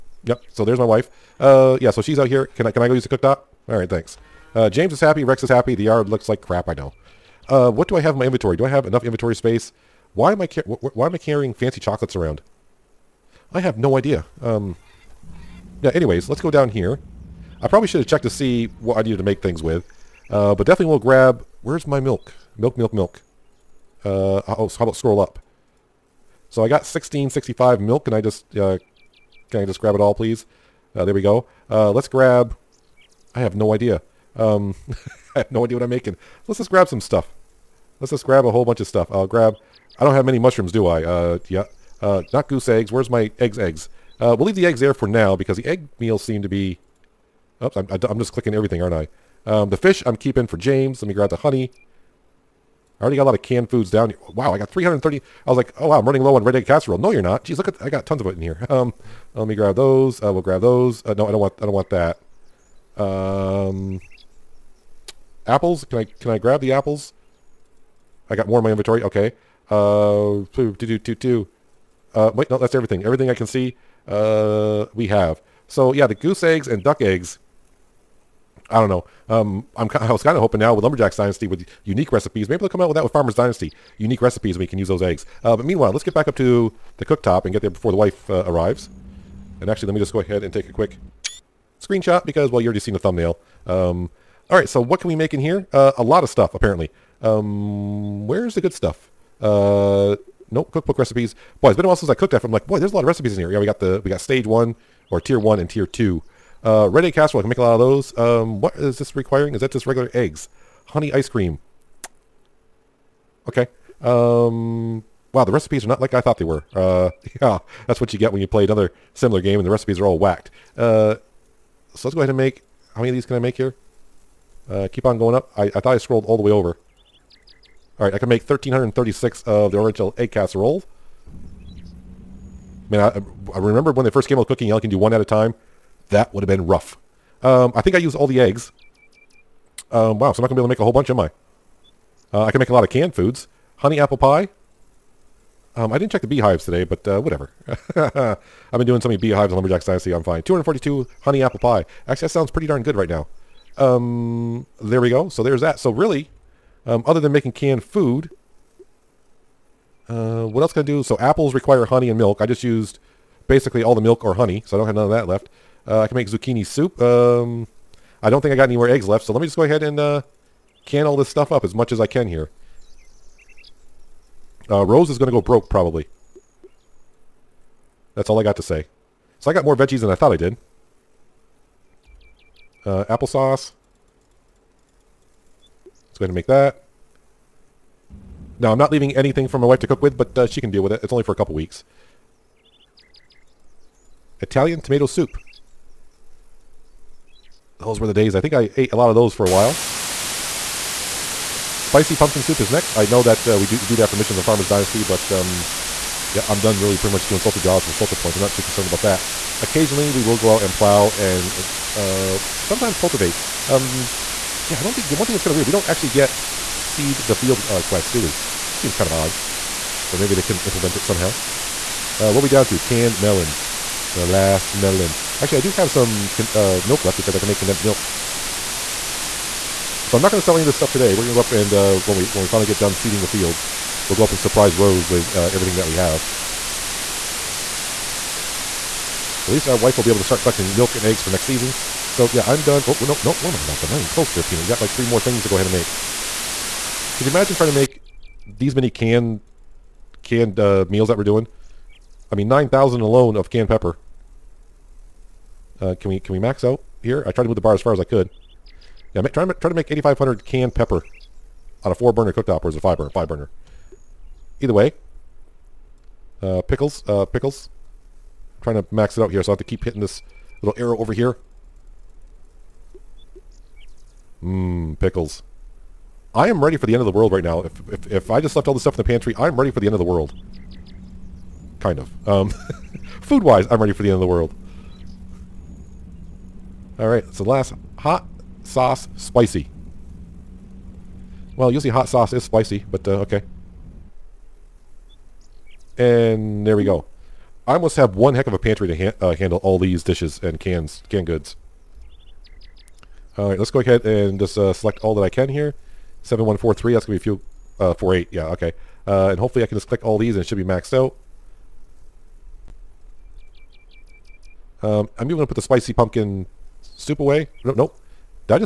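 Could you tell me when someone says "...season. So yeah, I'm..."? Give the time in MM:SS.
04:01.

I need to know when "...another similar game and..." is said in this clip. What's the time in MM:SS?
01:58.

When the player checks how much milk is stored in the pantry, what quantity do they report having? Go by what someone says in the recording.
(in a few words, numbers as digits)
1665.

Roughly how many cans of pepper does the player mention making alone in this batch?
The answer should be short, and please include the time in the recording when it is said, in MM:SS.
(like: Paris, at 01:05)
9,000, at 04:12.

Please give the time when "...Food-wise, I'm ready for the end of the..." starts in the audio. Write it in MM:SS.
04:43.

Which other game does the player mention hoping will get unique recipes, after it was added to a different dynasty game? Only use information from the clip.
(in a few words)
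Farmer's Dynasty.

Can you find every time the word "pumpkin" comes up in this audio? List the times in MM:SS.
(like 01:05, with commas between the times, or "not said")
03:22, 05:15.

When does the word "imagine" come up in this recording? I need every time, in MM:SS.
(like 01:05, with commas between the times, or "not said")
04:07.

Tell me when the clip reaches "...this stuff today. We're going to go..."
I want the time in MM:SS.
03:50.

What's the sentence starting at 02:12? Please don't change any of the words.
Man, I, I remember when they first came out with cooking, you only can do one at a time.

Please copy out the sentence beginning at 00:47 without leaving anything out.
Oops, I'm, I, am i am just clicking everything, aren't I?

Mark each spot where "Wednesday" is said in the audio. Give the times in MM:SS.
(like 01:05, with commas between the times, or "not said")
not said.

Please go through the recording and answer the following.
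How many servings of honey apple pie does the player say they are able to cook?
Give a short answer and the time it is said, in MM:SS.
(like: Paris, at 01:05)
242, at 02:30.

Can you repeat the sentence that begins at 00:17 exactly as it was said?
I probably should have checked to see what I needed to make things with.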